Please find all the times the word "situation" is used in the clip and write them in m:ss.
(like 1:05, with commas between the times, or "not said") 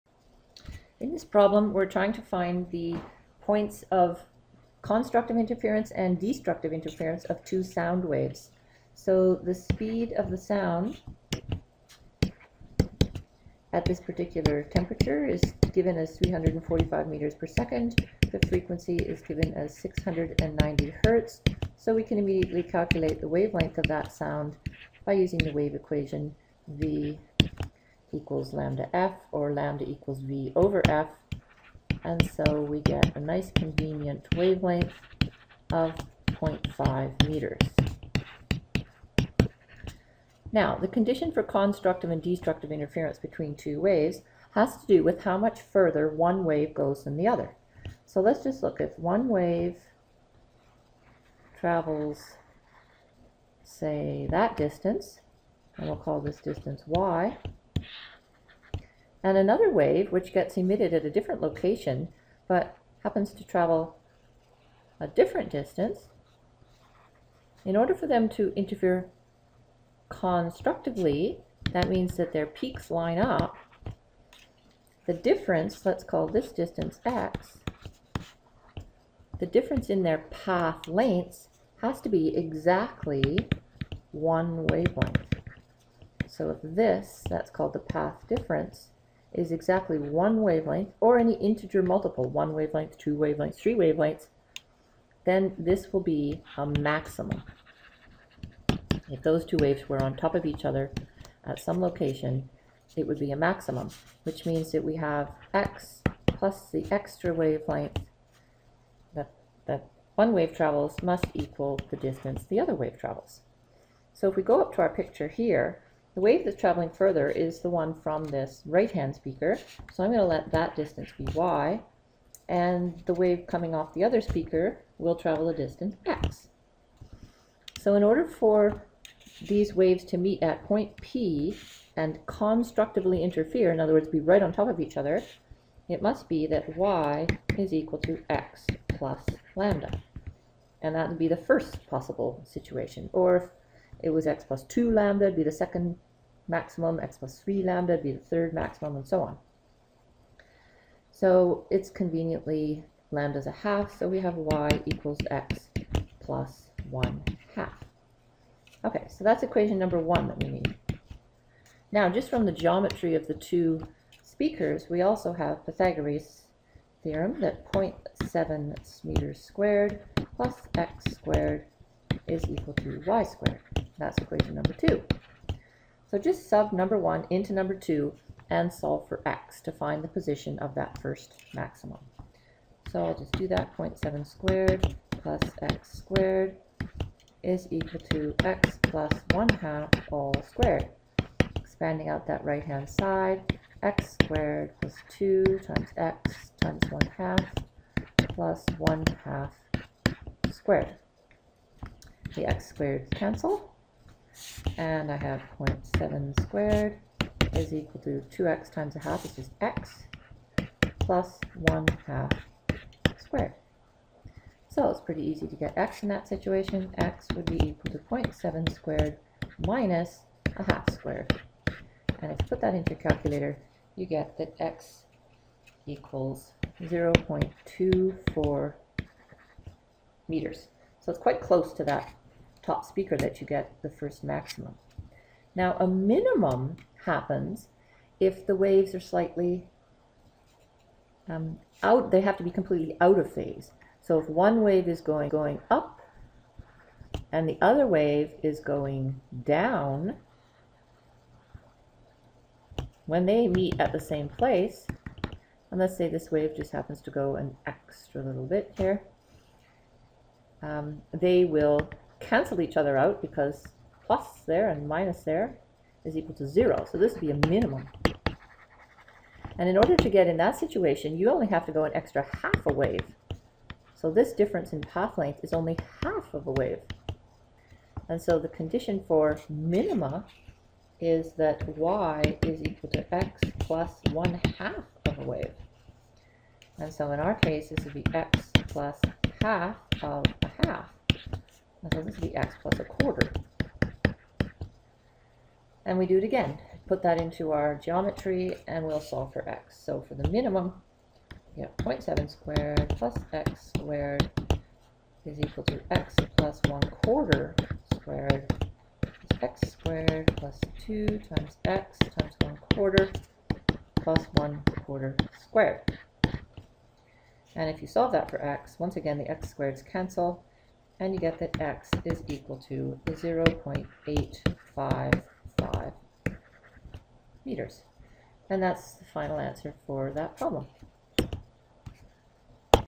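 2:22, 3:36, 4:30.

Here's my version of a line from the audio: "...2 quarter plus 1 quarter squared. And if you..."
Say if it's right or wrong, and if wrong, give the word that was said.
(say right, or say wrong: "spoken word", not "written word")
wrong: "1", not "2".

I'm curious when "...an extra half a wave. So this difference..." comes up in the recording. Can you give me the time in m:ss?
4:31.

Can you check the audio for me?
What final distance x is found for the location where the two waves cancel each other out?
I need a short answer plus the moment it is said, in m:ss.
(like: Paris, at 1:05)
0.855 meters, at 5:23.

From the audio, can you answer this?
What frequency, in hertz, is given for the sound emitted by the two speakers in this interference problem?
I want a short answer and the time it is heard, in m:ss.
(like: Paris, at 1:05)
690 hertz, at 0:19.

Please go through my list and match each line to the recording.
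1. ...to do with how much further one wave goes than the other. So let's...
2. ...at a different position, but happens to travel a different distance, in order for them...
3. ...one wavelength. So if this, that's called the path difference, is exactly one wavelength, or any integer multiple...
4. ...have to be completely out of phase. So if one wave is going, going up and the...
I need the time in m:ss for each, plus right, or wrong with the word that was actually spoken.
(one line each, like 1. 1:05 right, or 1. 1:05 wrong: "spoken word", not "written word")
1. 0:44 right
2. 1:00 wrong: "location", not "position"
3. 1:24 right
4. 4:02 right.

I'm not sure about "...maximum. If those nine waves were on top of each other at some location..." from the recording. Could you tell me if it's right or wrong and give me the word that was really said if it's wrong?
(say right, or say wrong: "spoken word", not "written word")
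wrong: "two", not "nine".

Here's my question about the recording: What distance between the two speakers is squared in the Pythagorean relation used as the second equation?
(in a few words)
0.7 meters.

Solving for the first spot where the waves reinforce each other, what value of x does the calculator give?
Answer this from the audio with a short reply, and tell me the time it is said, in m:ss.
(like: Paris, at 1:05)
0.24 meters, at 3:46.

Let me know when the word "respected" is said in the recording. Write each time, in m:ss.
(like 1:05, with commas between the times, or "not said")
not said.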